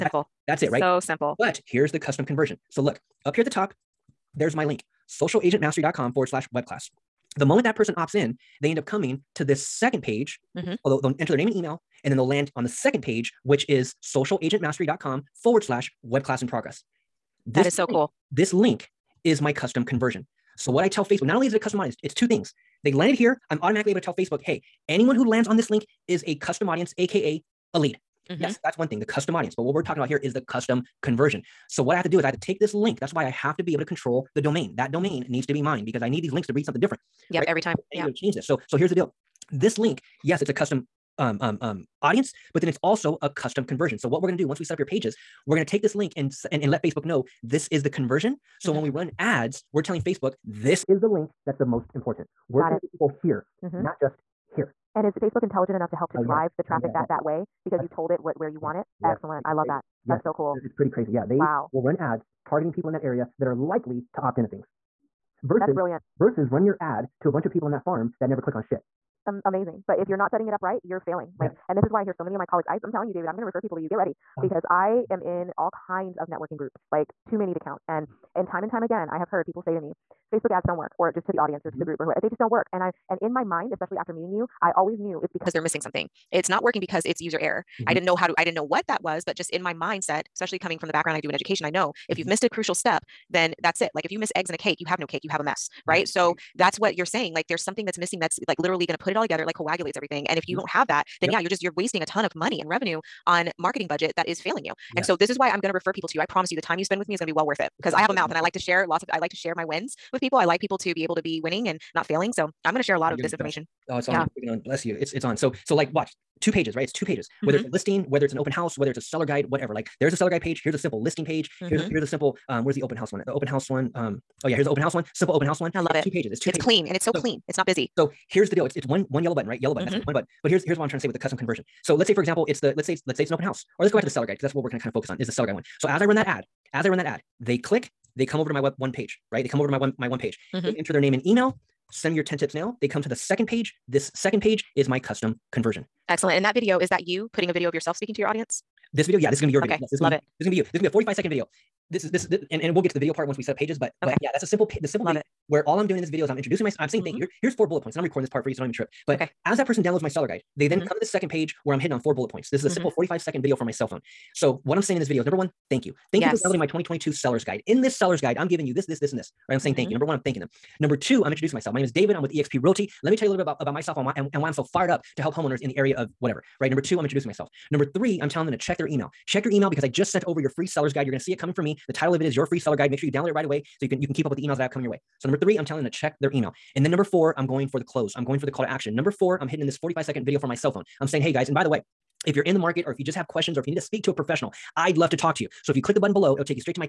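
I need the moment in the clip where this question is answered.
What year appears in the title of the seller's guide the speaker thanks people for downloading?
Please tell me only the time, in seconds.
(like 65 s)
166 s.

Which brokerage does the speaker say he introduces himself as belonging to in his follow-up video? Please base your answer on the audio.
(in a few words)
eXp Realty.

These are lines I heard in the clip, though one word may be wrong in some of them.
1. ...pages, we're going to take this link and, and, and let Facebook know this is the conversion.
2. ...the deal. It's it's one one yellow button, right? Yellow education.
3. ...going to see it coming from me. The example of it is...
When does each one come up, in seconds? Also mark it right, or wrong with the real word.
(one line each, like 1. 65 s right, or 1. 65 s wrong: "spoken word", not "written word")
1. 44 s right
2. 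128 s wrong: "button", not "education"
3. 181 s wrong: "title", not "example".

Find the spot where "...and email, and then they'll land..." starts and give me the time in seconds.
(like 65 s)
11 s.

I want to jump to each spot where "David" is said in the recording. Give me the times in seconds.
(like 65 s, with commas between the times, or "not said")
73 s, 171 s.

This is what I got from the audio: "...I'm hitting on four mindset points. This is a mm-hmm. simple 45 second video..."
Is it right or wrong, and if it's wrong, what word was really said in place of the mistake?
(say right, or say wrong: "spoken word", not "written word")
wrong: "bullet", not "mindset".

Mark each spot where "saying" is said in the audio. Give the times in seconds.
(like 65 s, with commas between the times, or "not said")
97 s, 156 s, 164 s, 169 s, 191 s.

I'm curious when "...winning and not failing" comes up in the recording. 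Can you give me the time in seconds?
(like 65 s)
111 s.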